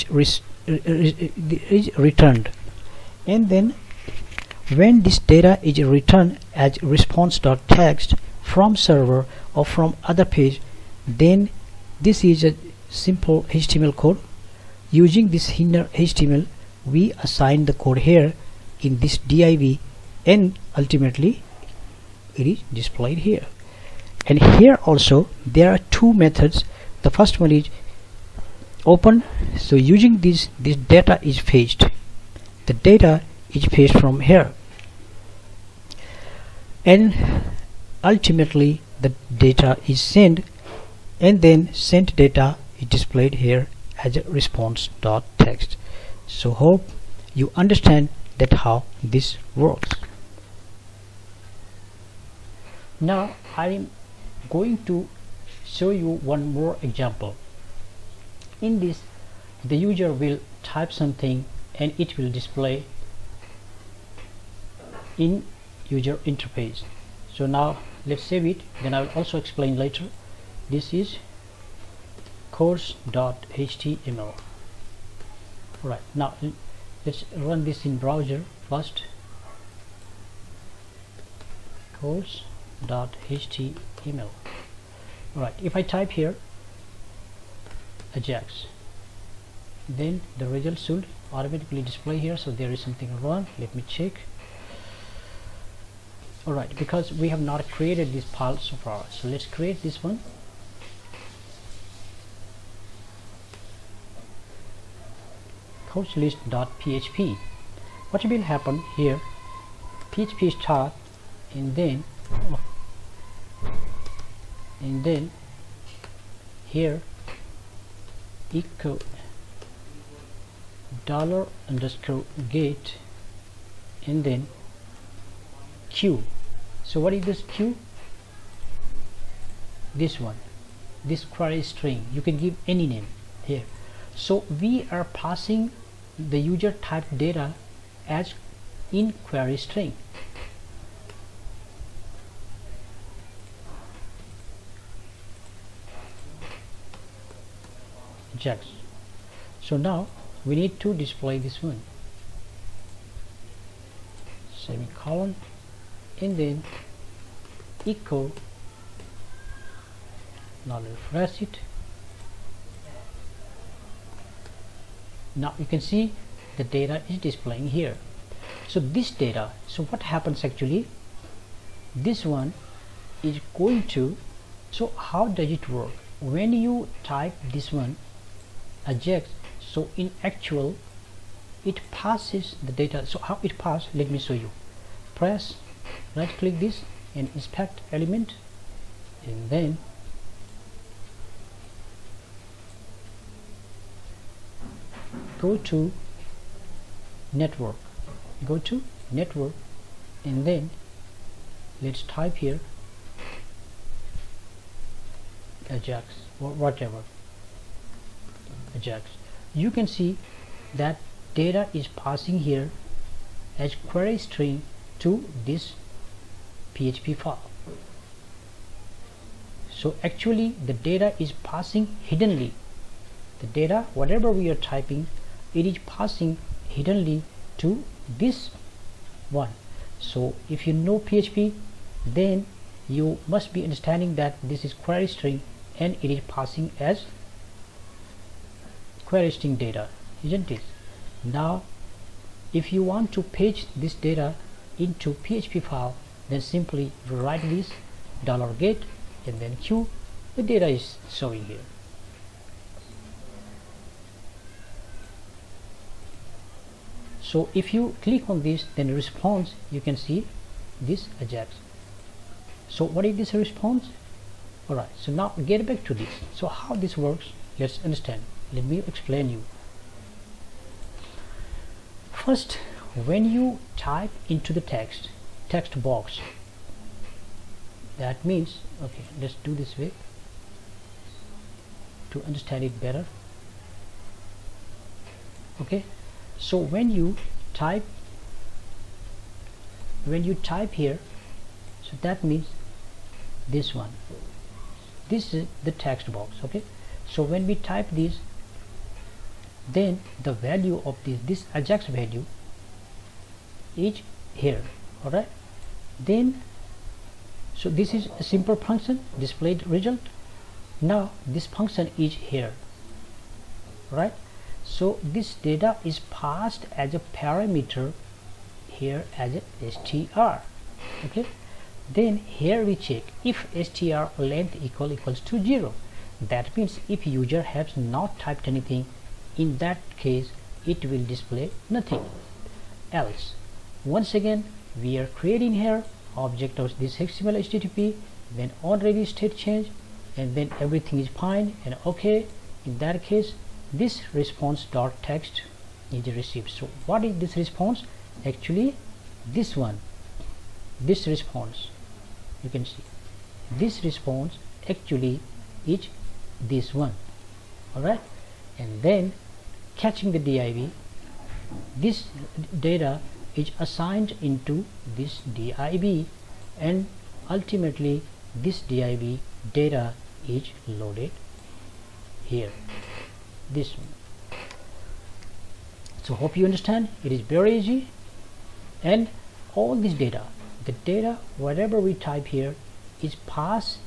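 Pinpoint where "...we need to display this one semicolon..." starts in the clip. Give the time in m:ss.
2:30.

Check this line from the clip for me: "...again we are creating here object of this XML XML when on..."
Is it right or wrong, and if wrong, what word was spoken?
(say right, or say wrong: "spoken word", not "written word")
wrong: "HTTP", not "XML".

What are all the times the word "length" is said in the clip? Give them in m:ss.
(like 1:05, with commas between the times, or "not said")
5:24.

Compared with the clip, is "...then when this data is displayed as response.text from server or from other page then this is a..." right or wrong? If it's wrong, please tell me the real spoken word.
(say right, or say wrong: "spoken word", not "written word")
wrong: "returned", not "displayed".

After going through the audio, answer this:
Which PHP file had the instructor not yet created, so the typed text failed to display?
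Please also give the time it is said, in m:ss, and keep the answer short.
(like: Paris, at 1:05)
coachlist.php, at 1:45.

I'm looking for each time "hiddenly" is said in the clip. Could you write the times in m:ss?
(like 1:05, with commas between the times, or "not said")
3:42, 3:46.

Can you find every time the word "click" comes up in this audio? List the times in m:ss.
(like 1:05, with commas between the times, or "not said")
3:06, 4:18.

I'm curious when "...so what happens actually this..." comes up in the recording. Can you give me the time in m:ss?
2:49.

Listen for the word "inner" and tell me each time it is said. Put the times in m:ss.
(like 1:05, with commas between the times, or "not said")
0:15.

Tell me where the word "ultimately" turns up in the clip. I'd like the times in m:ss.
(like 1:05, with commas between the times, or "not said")
0:20, 0:38, 6:07.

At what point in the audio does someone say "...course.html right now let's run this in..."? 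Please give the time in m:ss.
1:12.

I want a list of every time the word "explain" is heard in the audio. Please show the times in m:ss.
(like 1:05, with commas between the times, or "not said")
1:09, 4:28.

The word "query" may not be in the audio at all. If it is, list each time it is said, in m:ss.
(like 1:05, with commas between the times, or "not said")
2:11, 2:19, 3:33, 3:54, 3:59.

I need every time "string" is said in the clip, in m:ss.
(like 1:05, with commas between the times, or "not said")
2:11, 2:19, 3:34, 3:55, 3:59.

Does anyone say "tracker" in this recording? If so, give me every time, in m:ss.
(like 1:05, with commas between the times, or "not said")
not said.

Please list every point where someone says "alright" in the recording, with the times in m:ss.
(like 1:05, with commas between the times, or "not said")
4:24, 5:05, 5:57.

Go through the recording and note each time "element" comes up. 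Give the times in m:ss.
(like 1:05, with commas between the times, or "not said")
3:07.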